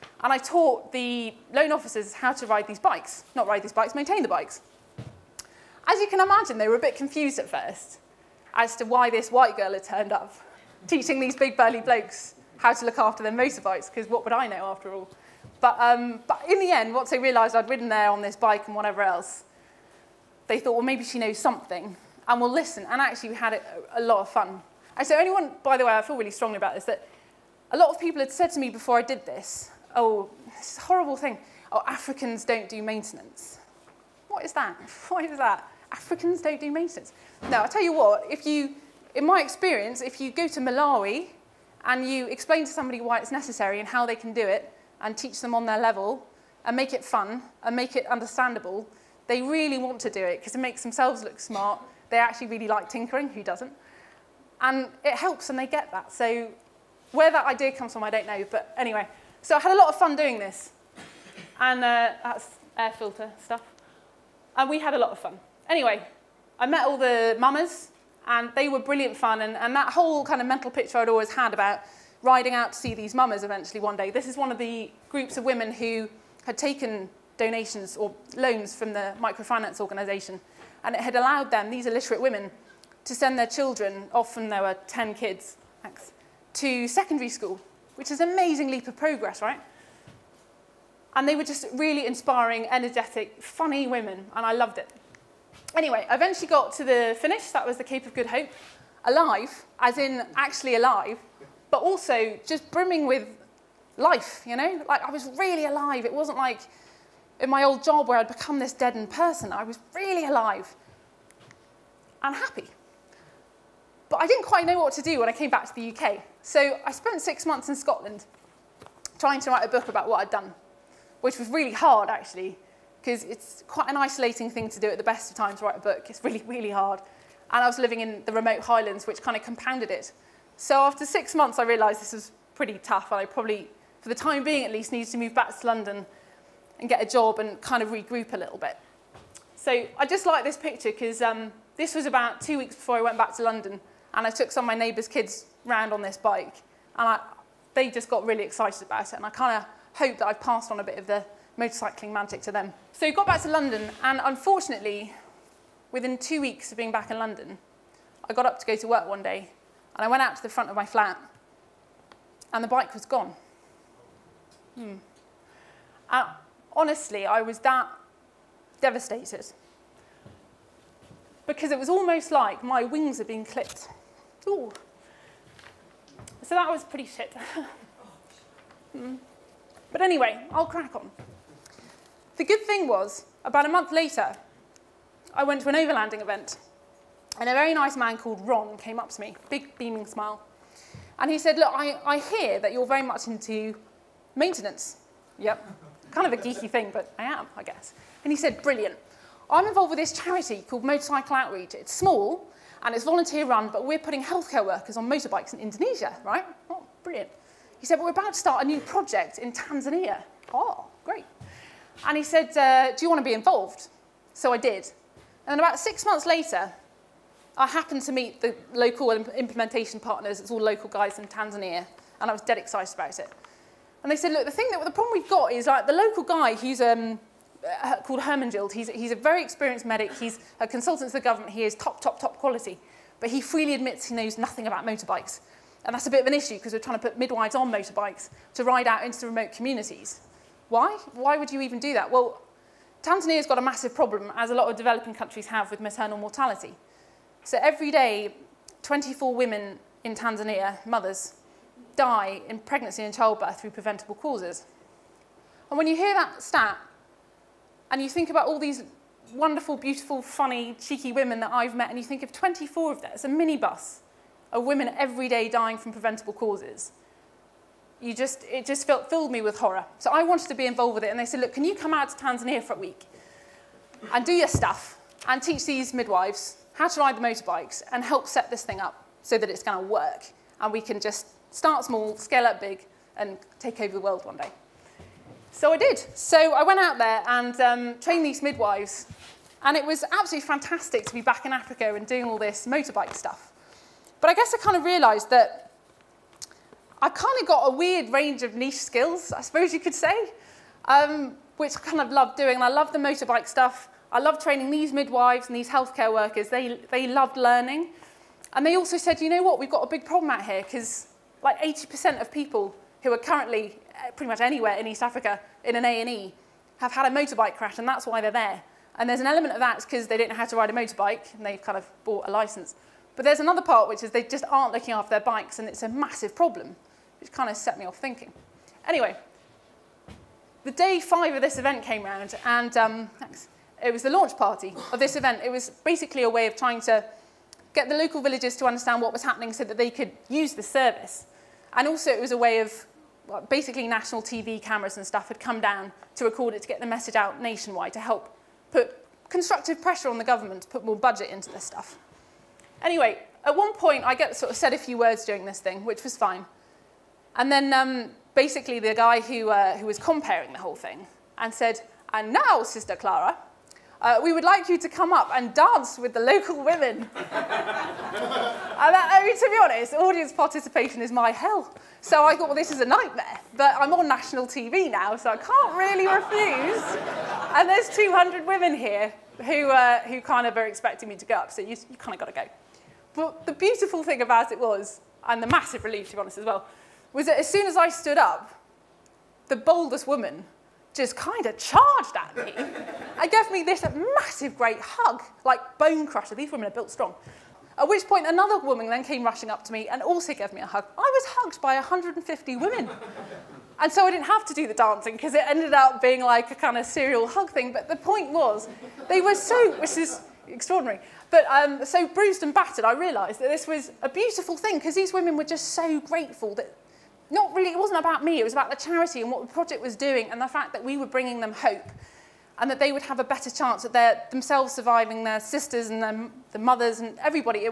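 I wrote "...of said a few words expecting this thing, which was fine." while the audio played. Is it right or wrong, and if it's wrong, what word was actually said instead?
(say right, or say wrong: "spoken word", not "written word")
wrong: "during", not "expecting".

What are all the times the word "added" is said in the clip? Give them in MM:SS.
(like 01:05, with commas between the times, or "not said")
not said.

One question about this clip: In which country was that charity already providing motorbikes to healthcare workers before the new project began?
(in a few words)
Indonesia.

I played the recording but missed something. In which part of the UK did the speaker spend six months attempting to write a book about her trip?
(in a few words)
Scotland.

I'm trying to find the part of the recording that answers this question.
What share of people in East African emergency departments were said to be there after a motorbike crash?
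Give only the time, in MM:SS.
05:11.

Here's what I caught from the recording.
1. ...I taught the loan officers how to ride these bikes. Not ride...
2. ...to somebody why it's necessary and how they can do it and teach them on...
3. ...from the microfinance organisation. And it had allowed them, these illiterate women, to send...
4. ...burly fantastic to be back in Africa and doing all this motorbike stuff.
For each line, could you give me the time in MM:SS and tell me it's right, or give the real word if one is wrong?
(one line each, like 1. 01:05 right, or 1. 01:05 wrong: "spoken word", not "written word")
1. 00:00 right
2. 00:42 right
3. 01:18 right
4. 04:50 wrong: "absolutely", not "burly".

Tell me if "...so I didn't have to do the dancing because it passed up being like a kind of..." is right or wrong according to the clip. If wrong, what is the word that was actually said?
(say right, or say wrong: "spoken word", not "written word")
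wrong: "ended", not "passed".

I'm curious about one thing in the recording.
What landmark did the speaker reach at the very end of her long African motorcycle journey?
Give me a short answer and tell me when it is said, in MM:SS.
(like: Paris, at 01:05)
Cape of Good Hope, at 01:37.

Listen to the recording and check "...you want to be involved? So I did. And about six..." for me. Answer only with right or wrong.
right.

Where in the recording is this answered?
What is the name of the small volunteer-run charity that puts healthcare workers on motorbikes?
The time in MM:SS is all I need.
03:20.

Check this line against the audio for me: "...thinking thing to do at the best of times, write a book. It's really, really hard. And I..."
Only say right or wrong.
wrong.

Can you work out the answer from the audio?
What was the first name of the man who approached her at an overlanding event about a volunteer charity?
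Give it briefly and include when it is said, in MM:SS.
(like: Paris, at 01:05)
Ron, at 03:08.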